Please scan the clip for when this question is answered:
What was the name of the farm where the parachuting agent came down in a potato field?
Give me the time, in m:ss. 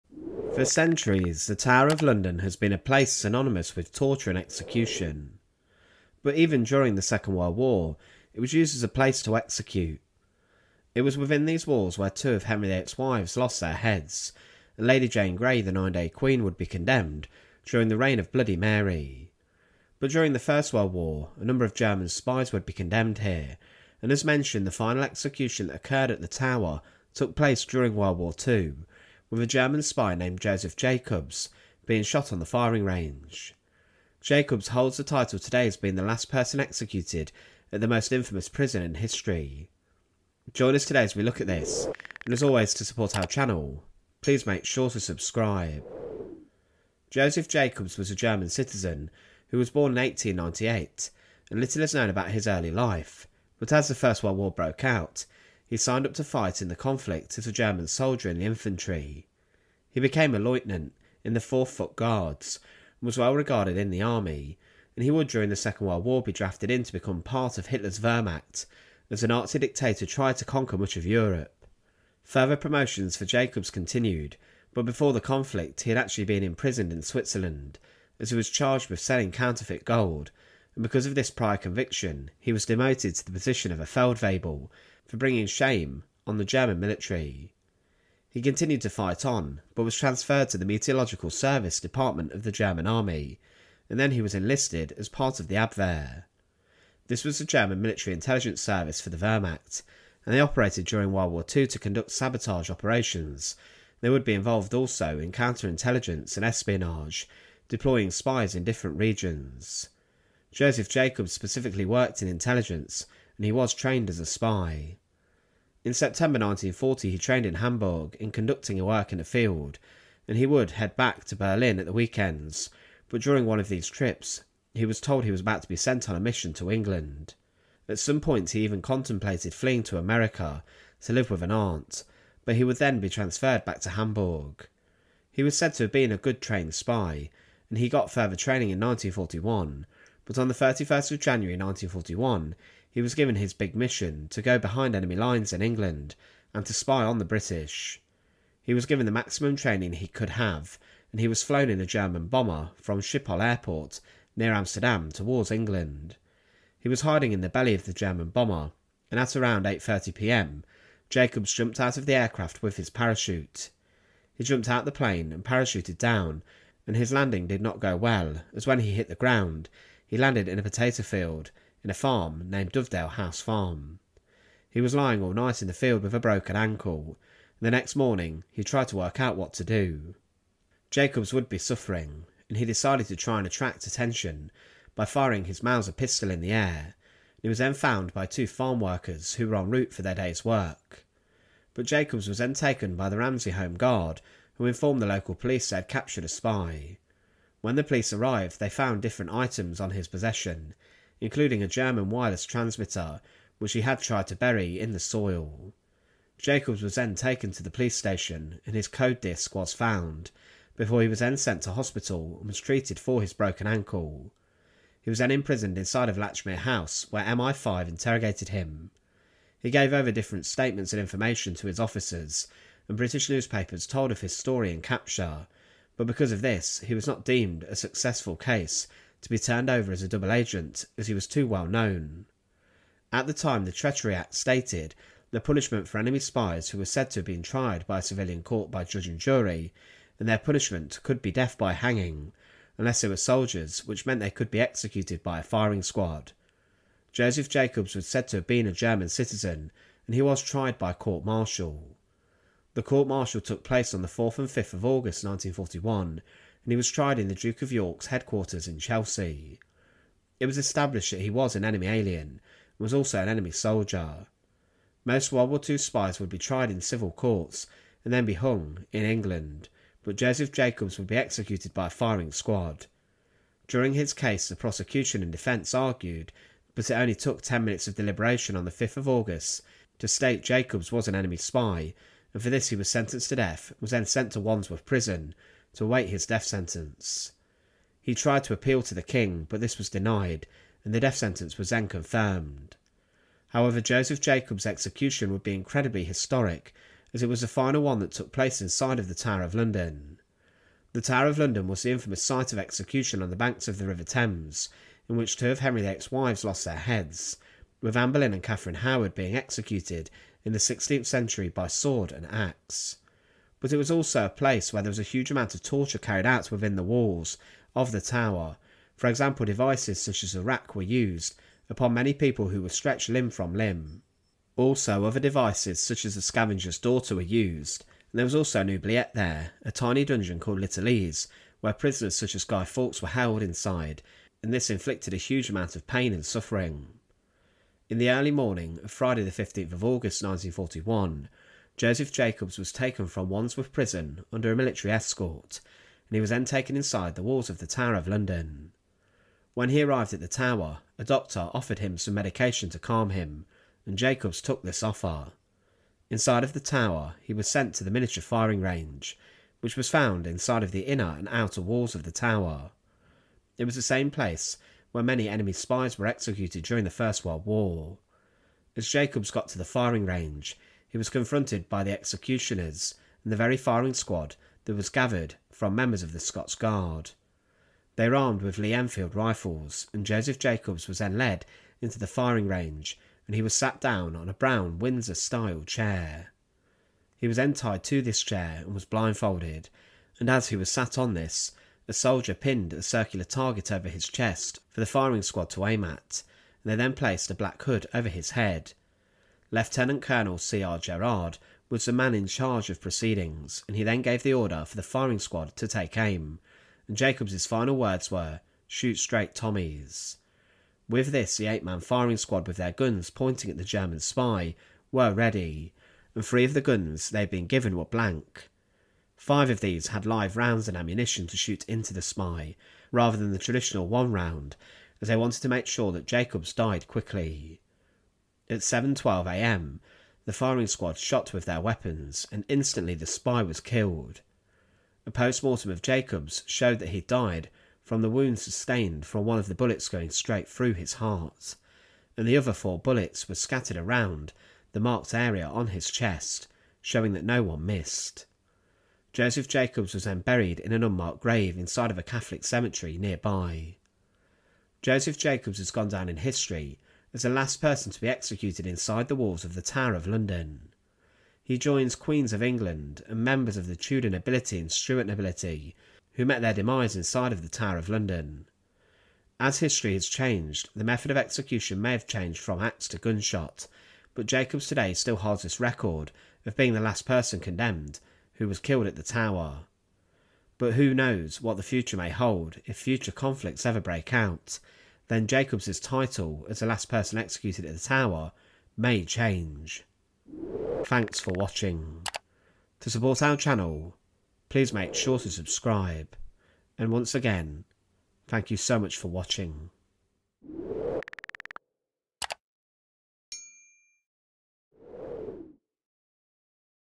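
2:52.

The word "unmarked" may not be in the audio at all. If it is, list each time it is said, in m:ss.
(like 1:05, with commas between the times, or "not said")
7:30.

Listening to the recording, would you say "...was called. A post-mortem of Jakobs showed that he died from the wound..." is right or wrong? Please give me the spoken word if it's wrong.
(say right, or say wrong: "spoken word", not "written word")
wrong: "killed", not "called".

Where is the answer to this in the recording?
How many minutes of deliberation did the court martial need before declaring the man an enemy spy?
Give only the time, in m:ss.
4:37.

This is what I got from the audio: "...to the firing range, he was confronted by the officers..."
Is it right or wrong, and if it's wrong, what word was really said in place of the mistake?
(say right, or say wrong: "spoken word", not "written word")
wrong: "executioners", not "officers".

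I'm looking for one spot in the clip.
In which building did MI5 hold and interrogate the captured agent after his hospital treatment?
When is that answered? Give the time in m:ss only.
3:36.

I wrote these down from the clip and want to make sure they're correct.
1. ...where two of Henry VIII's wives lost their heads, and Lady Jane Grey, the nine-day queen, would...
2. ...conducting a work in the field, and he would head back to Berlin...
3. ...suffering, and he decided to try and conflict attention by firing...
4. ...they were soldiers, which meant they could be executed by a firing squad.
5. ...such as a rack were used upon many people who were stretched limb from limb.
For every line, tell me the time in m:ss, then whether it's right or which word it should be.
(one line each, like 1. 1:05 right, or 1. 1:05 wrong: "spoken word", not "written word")
1. 0:11 right
2. 1:58 right
3. 3:01 wrong: "attract", not "conflict"
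4. 4:03 right
5. 5:20 right.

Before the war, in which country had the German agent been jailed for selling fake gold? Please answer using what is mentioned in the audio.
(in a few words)
Switzerland.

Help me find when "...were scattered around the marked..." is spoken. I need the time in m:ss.
7:23.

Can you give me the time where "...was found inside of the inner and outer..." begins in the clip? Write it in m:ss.
5:59.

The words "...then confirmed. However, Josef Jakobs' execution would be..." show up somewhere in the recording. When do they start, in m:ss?
4:51.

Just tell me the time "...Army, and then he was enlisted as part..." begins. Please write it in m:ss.
1:32.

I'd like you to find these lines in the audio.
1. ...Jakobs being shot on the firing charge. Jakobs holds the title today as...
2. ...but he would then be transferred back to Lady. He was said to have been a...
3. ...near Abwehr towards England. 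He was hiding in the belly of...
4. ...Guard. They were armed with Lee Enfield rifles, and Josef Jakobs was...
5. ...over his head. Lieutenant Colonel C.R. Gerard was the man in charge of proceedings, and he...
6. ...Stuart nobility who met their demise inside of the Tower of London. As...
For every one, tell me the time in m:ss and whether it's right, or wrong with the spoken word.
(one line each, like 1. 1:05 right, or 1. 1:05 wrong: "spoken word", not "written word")
1. 0:30 wrong: "range", not "charge"
2. 2:12 wrong: "Hamburg", not "Lady"
3. 2:34 wrong: "Amsterdam", not "Abwehr"
4. 6:16 right
5. 6:37 right
6. 7:44 right.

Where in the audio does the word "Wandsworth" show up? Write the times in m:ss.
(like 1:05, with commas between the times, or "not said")
4:44, 5:43.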